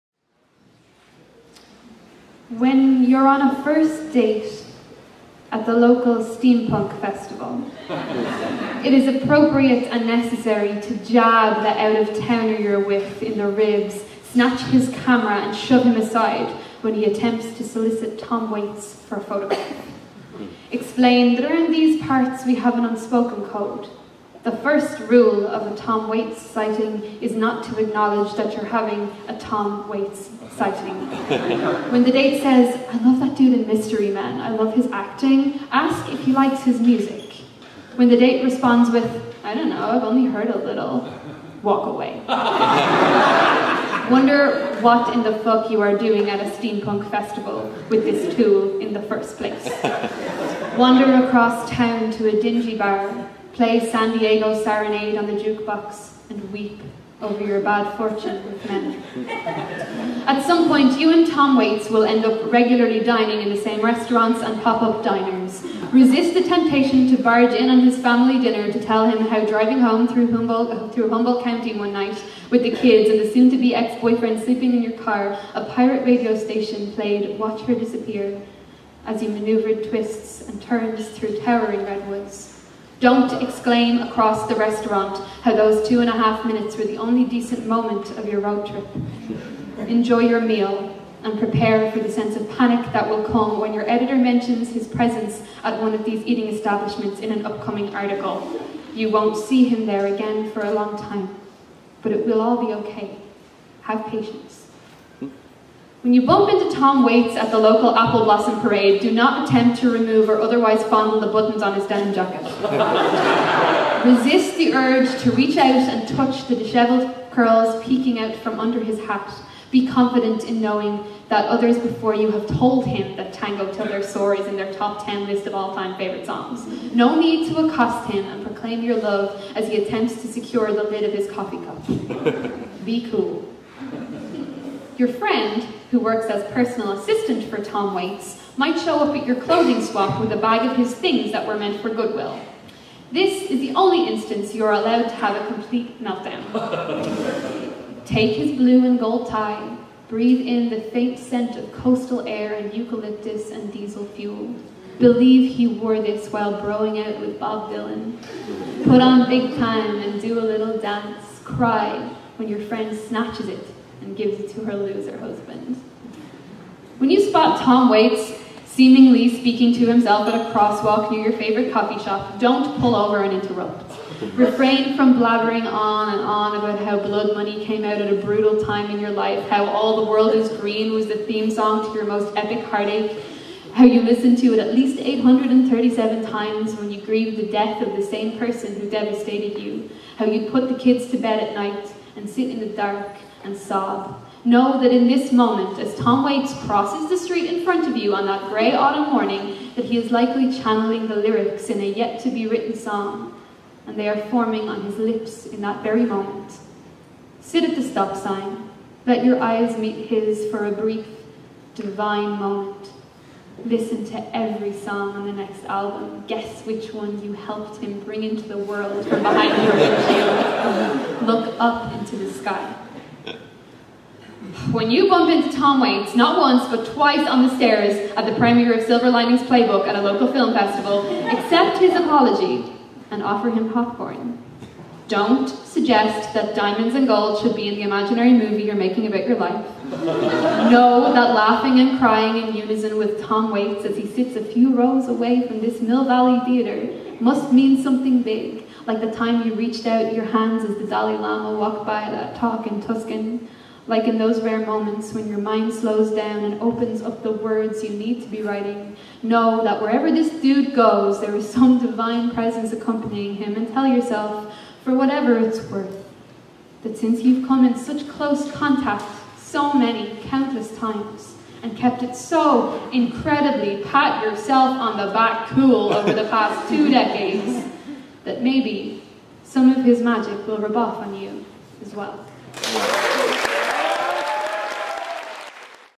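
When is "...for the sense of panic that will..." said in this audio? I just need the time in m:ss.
1:31.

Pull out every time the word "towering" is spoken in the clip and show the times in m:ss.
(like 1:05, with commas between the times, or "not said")
1:21.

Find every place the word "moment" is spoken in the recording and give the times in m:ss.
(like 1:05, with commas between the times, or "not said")
1:27, 3:15, 3:26, 3:32, 4:14.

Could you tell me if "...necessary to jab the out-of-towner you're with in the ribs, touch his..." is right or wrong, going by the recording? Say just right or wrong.
wrong.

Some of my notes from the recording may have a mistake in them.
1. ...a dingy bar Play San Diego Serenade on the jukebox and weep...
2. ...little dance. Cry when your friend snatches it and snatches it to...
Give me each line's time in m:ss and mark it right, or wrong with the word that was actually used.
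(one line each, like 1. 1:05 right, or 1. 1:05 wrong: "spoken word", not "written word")
1. 0:52 right
2. 2:40 wrong: "gives", not "snatches".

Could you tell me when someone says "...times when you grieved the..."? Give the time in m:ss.
3:06.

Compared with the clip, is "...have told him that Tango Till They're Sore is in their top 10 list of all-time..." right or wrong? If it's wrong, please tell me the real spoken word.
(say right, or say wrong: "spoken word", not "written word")
right.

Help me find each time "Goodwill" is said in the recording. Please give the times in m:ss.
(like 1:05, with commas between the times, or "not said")
2:21.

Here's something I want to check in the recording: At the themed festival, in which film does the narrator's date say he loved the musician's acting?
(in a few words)
Mystery Man.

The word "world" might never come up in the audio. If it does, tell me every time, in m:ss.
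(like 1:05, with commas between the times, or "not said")
3:00, 3:38.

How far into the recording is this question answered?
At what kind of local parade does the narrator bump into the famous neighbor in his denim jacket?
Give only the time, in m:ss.
1:47.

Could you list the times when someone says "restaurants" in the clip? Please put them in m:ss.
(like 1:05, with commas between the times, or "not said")
1:03, 1:24.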